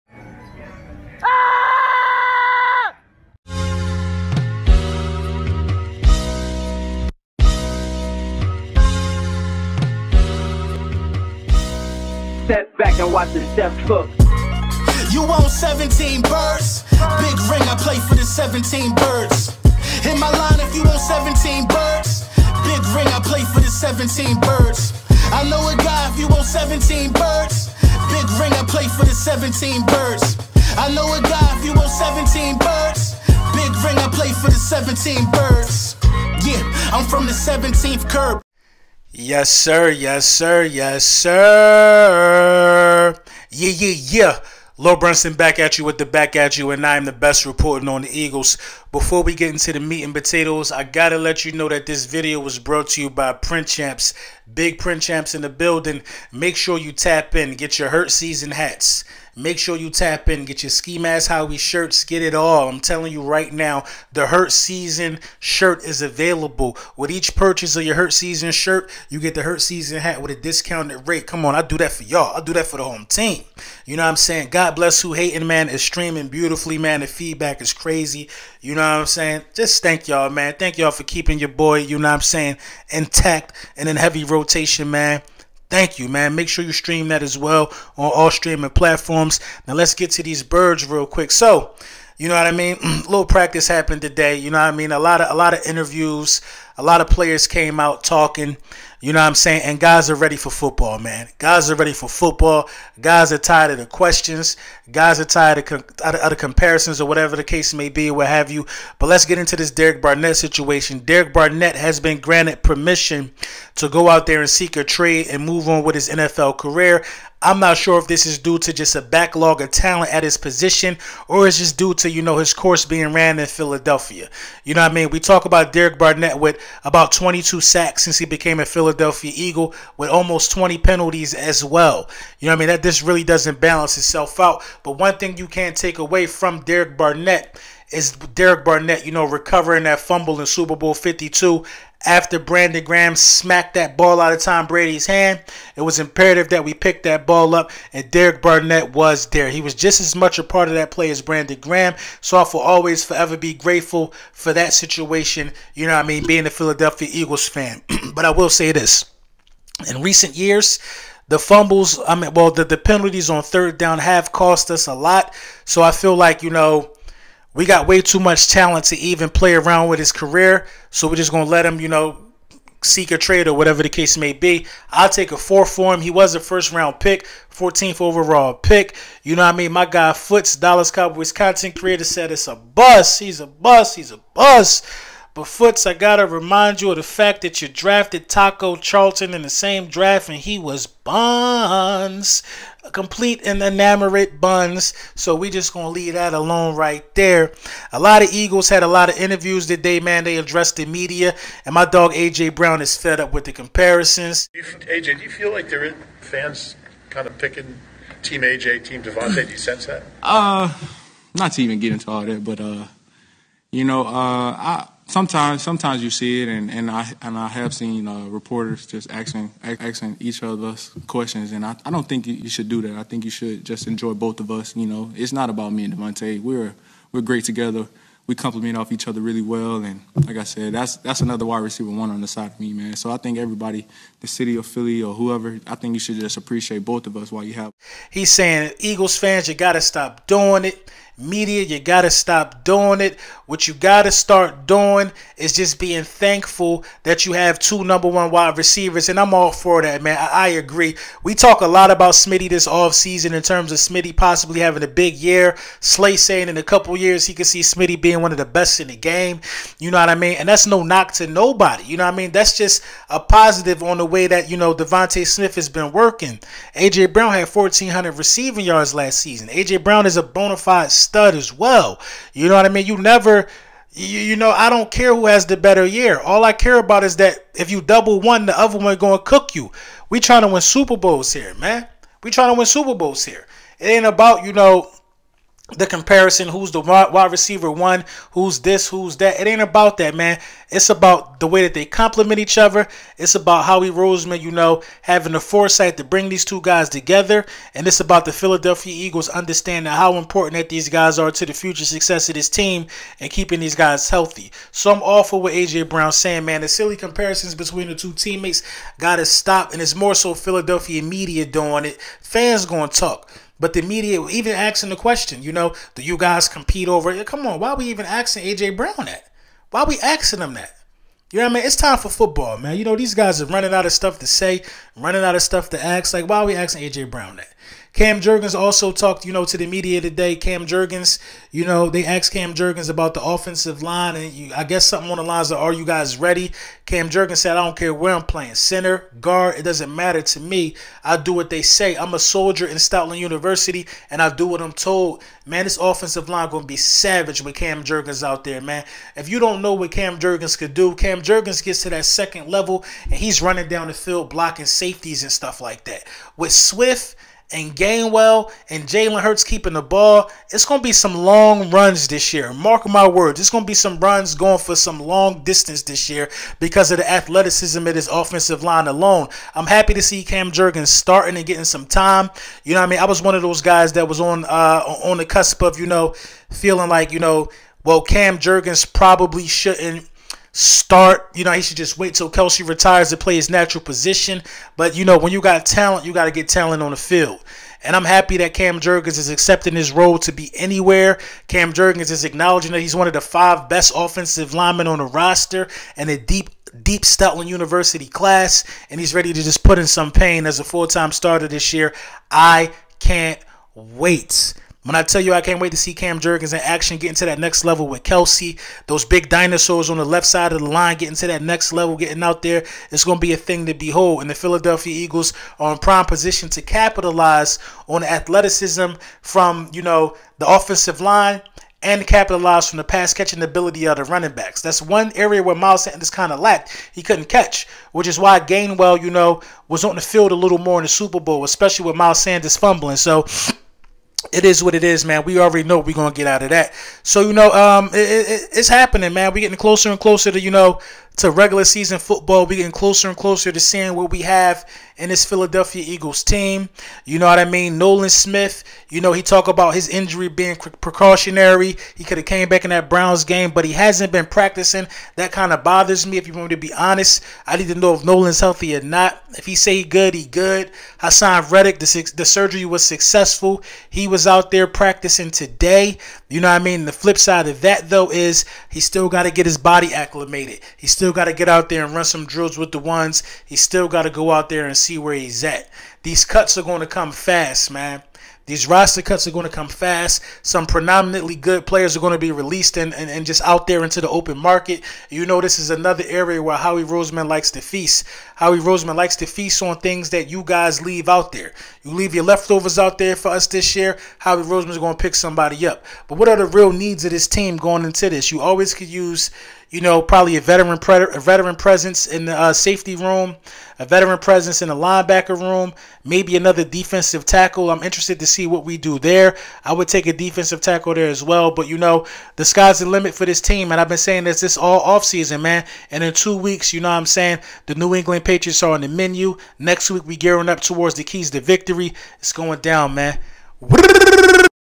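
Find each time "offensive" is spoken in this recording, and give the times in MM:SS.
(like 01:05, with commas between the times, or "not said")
05:33, 05:45, 06:08, 06:33, 07:00.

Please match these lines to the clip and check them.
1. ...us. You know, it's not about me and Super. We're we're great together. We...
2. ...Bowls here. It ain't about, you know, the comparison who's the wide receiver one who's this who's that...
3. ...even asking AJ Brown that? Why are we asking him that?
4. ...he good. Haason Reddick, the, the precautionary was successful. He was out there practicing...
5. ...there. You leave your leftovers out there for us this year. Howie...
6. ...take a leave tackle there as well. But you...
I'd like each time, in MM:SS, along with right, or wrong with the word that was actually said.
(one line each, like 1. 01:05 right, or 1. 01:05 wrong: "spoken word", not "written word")
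1. 03:44 wrong: "DeVonta", not "Super"
2. 04:42 right
3. 05:17 right
4. 07:40 wrong: "surgery", not "precautionary"
5. 08:11 right
6. 08:29 wrong: "defensive", not "leave".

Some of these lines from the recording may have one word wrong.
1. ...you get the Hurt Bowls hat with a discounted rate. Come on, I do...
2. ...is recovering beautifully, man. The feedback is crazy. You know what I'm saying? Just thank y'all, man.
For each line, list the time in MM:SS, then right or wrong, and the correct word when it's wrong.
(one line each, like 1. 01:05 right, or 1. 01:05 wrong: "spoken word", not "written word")
1. 01:09 wrong: "Season", not "Bowls"
2. 01:15 wrong: "streaming", not "recovering".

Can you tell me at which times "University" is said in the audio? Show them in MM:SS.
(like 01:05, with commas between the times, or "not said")
05:43, 06:37.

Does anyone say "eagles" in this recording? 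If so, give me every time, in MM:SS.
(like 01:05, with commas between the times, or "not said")
00:48, 02:09, 02:37, 03:18, 03:58, 04:58, 06:54, 07:25.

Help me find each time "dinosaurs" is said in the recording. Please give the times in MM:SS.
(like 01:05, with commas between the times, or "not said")
06:49.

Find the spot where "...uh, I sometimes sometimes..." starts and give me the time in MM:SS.
03:34.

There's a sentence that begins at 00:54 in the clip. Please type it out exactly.
Big Print Champs in the building.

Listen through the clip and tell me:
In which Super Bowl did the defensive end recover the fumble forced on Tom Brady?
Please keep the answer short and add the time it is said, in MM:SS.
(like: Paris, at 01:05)
Super Bowl 52, at 02:20.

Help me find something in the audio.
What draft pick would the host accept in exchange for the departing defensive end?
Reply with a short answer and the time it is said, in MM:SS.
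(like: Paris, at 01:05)
a four, at 02:55.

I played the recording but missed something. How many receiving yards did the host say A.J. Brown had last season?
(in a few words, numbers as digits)
1,400.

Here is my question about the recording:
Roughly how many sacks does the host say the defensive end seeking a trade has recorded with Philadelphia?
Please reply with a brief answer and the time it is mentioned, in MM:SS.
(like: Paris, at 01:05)
22, at 02:07.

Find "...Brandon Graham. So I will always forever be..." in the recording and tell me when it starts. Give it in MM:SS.
02:31.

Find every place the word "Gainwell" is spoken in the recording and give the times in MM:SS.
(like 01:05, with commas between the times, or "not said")
05:57, 07:08.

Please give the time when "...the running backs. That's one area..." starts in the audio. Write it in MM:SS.
07:03.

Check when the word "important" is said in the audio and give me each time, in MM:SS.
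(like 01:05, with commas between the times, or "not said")
05:00.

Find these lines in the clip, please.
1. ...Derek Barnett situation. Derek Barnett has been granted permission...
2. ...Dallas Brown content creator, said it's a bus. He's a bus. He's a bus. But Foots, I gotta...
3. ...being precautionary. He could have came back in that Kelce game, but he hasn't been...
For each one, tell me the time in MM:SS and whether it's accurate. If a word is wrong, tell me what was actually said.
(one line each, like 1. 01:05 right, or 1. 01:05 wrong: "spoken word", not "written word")
1. 01:49 right
2. 03:00 wrong: "Cowboys", not "Brown"
3. 07:30 wrong: "Browns", not "Kelce".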